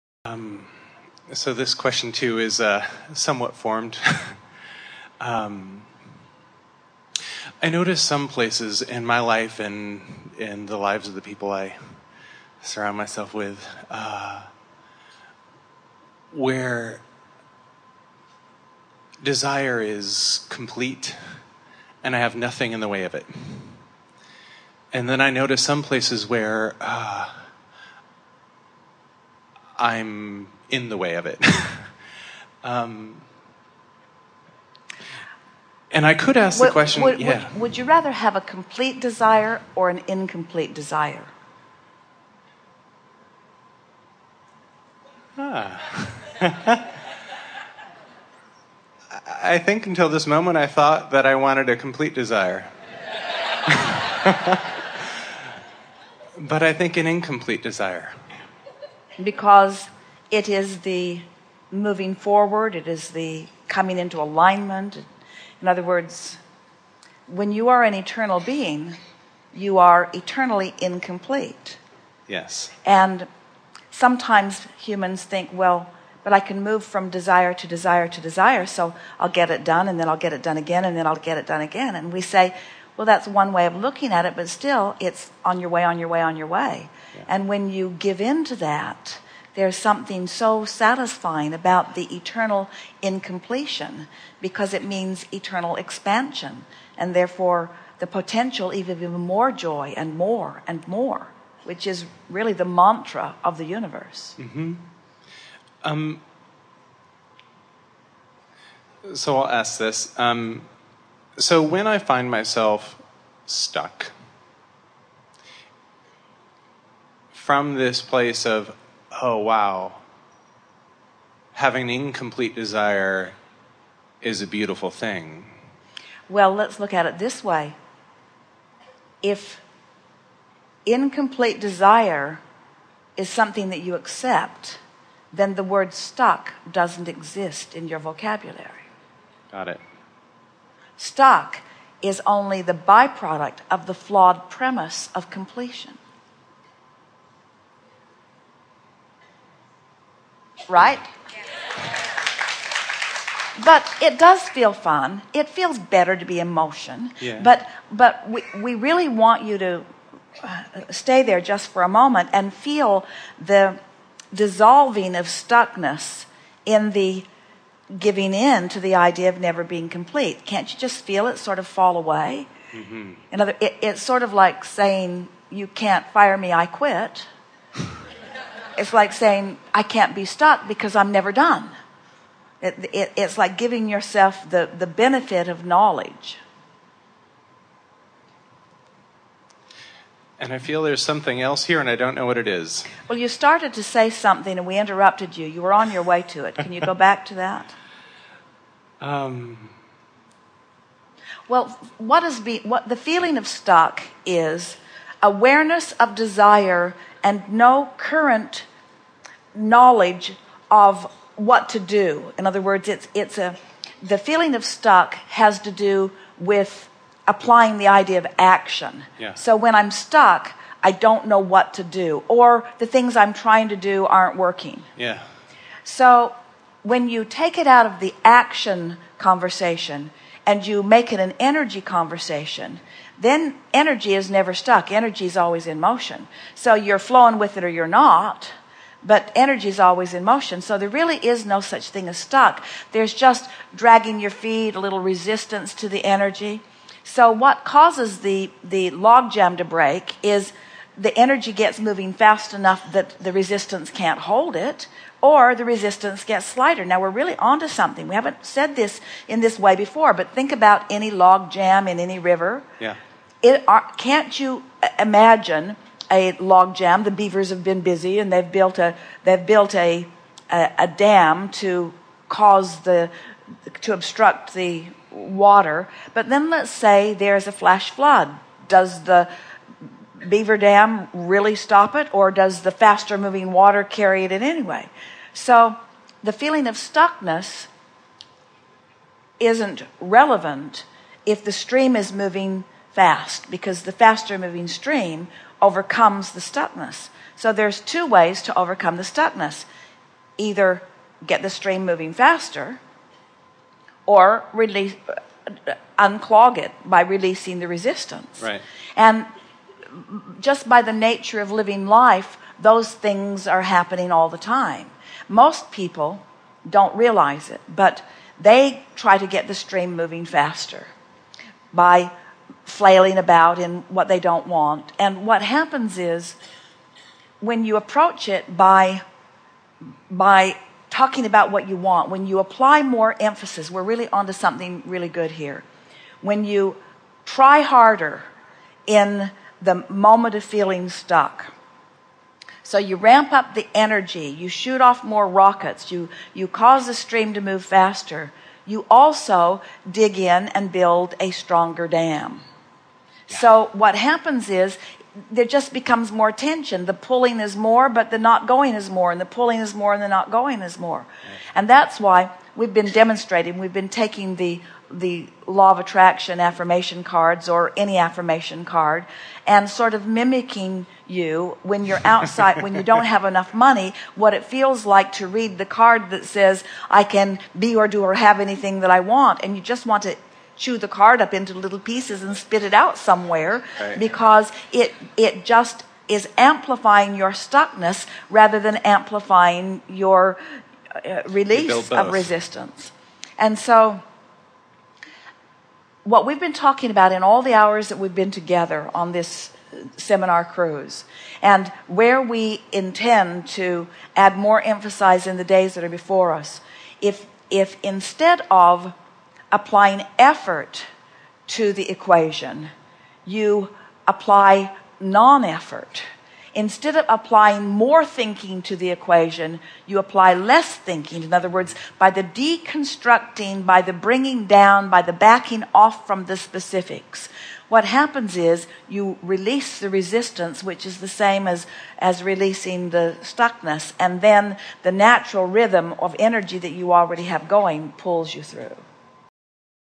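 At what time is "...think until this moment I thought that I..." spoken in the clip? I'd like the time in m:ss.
0:49.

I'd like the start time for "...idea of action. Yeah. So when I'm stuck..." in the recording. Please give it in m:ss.
3:37.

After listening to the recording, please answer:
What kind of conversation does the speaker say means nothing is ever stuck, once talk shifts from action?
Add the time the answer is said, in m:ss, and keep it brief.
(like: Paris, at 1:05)
An energy conversation, at 3:51.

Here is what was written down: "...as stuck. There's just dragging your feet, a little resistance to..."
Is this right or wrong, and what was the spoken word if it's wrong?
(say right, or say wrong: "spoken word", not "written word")
right.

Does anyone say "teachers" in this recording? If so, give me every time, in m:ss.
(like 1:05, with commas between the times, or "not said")
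not said.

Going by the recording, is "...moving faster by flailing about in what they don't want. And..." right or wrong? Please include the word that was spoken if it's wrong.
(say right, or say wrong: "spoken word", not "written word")
right.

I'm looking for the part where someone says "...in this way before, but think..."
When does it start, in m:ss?
4:19.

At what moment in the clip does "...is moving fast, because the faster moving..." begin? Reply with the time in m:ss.
4:51.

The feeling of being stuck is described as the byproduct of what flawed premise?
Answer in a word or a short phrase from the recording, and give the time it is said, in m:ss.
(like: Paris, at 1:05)
Completion, at 2:23.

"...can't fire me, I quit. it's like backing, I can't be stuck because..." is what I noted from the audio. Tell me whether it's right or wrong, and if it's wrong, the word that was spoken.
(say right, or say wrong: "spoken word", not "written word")
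wrong: "saying", not "backing".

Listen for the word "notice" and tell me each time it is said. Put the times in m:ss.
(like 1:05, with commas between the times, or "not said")
0:07, 0:25.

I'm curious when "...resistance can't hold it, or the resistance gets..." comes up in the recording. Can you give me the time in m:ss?
4:13.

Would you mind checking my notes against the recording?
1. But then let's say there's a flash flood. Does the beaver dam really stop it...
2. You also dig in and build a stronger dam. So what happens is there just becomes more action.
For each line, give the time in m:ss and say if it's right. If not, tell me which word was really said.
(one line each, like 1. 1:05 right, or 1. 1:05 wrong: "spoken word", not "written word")
1. 4:36 right
2. 5:48 wrong: "tension", not "action".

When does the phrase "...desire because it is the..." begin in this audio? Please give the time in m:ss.
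0:57.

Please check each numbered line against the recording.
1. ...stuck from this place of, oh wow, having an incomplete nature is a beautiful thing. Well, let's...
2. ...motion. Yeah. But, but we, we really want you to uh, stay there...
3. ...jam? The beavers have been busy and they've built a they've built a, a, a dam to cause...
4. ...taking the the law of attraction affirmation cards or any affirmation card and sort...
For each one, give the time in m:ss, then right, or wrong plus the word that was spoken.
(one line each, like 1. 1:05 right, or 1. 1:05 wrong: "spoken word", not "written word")
1. 1:53 wrong: "desire", not "nature"
2. 2:36 right
3. 4:26 right
4. 6:03 right.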